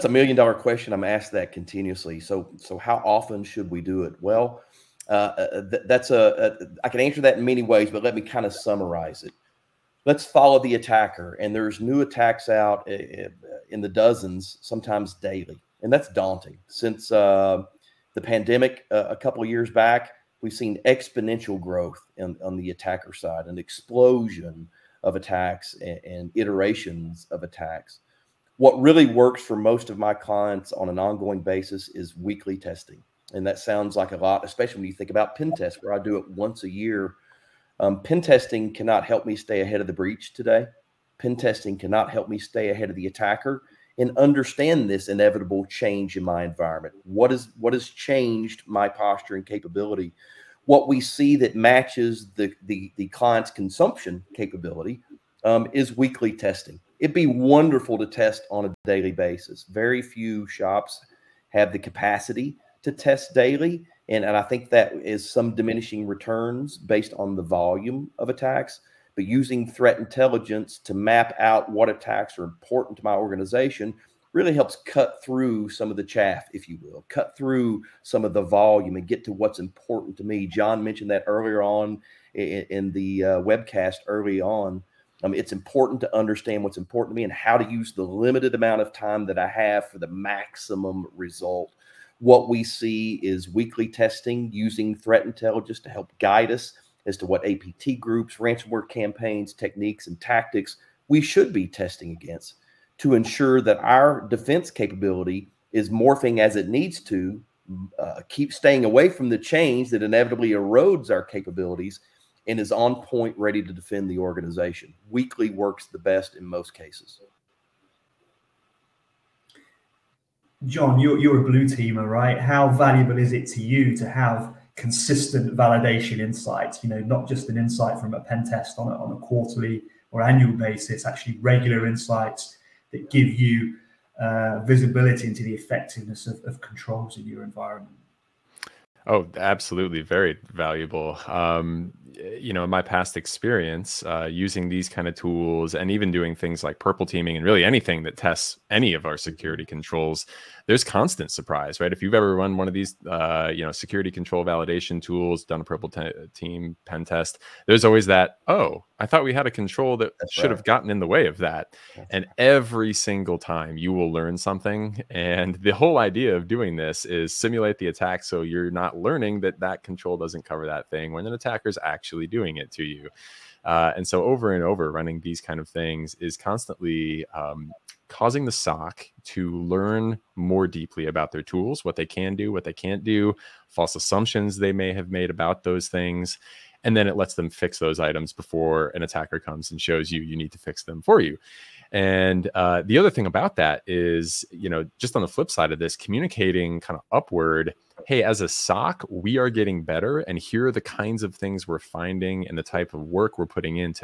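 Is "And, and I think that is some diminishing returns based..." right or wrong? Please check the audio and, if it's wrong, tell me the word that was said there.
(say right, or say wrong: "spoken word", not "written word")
right.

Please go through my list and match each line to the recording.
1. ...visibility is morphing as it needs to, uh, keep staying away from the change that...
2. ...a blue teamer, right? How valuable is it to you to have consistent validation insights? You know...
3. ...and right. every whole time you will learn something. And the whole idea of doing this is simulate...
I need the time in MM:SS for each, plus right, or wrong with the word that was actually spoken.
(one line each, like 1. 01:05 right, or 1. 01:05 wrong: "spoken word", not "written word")
1. 01:44 wrong: "capability", not "visibility"
2. 02:01 right
3. 02:42 wrong: "single", not "whole".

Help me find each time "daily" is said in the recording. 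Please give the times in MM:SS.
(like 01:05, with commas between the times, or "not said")
00:15, 00:58, 01:03.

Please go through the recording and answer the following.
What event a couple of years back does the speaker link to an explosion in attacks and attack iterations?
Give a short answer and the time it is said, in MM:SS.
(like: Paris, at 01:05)
The pandemic, at 00:18.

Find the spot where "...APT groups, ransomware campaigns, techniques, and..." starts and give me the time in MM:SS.
01:37.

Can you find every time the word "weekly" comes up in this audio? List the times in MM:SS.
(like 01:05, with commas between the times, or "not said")
00:32, 00:55, 01:33, 01:55.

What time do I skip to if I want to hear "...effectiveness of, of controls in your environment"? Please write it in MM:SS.
02:15.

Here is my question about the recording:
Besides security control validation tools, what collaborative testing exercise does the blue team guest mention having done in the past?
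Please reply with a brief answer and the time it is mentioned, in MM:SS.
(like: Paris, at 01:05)
Purple teaming, at 02:26.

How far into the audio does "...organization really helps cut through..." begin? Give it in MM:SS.
01:13.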